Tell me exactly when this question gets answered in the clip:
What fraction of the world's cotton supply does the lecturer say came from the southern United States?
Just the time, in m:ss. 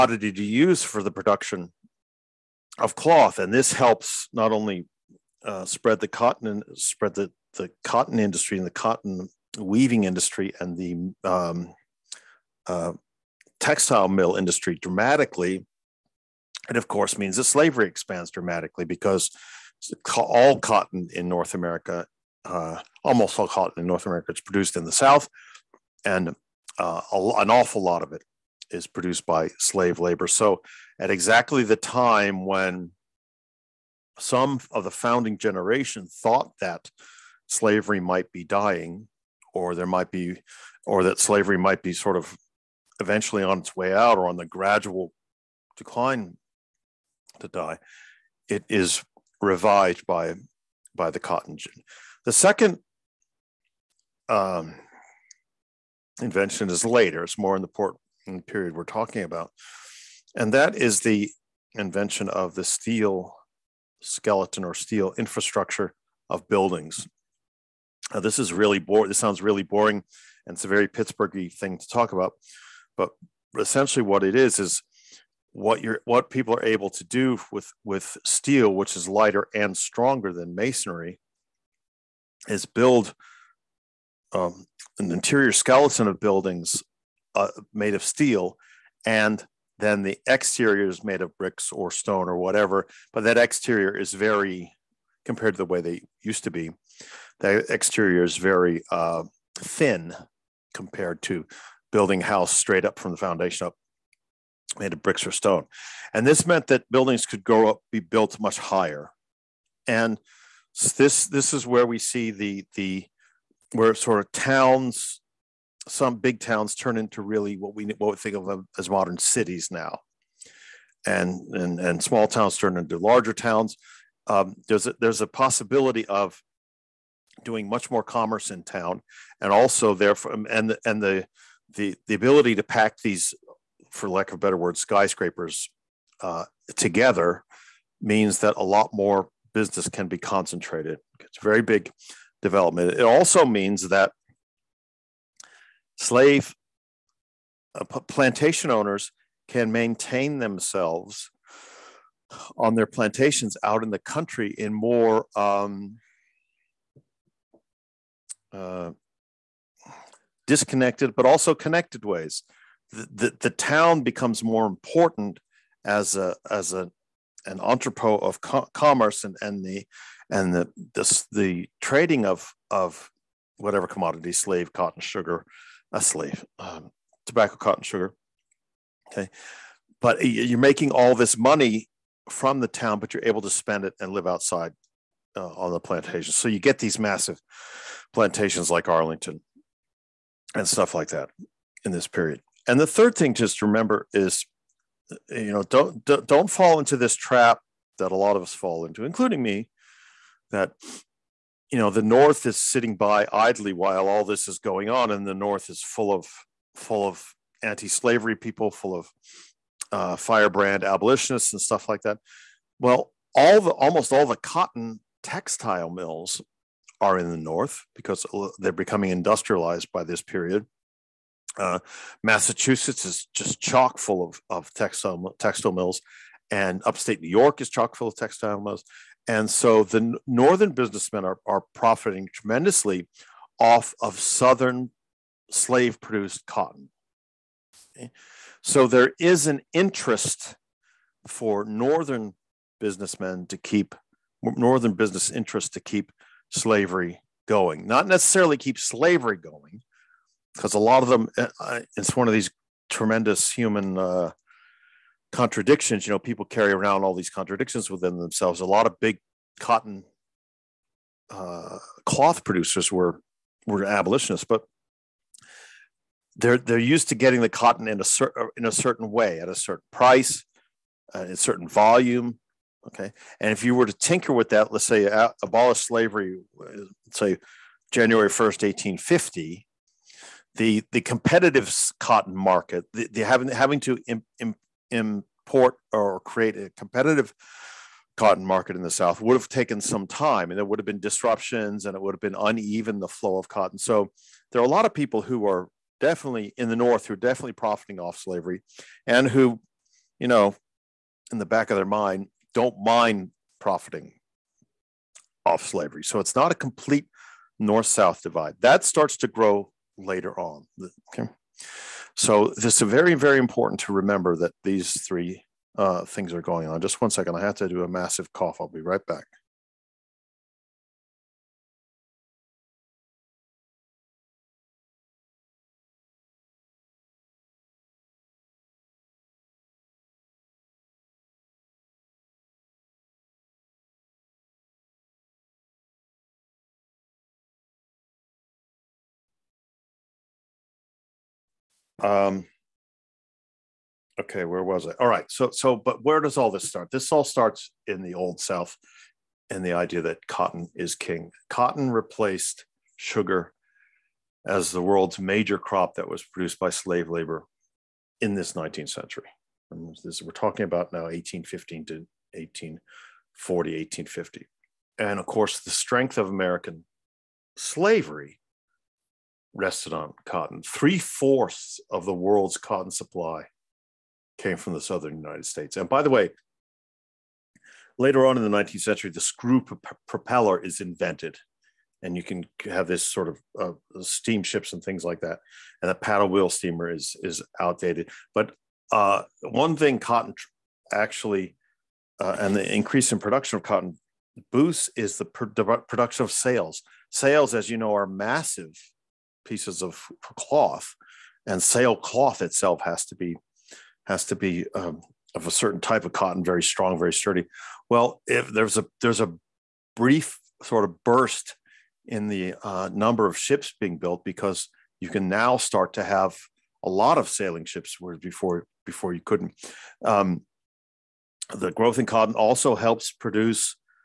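6:10.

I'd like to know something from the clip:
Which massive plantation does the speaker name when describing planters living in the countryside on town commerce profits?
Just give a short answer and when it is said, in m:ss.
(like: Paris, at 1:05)
Arlington, at 3:08.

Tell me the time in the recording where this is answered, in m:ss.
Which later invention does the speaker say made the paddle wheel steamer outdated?
6:19.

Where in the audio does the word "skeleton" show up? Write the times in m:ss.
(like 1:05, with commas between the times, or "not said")
1:04, 1:25.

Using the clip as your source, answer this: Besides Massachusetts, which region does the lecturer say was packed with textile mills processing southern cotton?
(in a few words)
Upstate New York.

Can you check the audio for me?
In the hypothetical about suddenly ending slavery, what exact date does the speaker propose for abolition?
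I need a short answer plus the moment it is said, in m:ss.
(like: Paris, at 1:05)
January 1st 1850, at 4:37.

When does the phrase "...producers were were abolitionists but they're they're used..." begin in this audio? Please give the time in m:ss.
4:22.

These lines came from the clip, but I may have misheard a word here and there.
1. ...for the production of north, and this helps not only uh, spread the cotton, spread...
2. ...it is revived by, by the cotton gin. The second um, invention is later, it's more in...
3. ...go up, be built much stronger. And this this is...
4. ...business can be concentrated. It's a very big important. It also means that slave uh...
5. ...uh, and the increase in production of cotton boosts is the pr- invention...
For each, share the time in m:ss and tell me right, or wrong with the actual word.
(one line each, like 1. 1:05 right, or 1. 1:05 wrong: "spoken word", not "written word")
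1. 0:00 wrong: "cloth", not "north"
2. 0:48 right
3. 1:47 wrong: "higher", not "stronger"
4. 2:19 wrong: "development", not "important"
5. 6:32 wrong: "production", not "invention".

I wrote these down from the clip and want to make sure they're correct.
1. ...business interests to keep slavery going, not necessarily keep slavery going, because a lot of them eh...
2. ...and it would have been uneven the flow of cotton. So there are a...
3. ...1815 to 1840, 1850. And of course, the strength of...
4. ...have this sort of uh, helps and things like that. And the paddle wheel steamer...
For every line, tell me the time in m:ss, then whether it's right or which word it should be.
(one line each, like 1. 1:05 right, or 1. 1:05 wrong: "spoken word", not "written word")
1. 4:04 right
2. 4:51 right
3. 6:01 right
4. 6:22 wrong: "steamships", not "helps".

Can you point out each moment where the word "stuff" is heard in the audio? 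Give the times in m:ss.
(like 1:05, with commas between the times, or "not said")
3:10, 3:31.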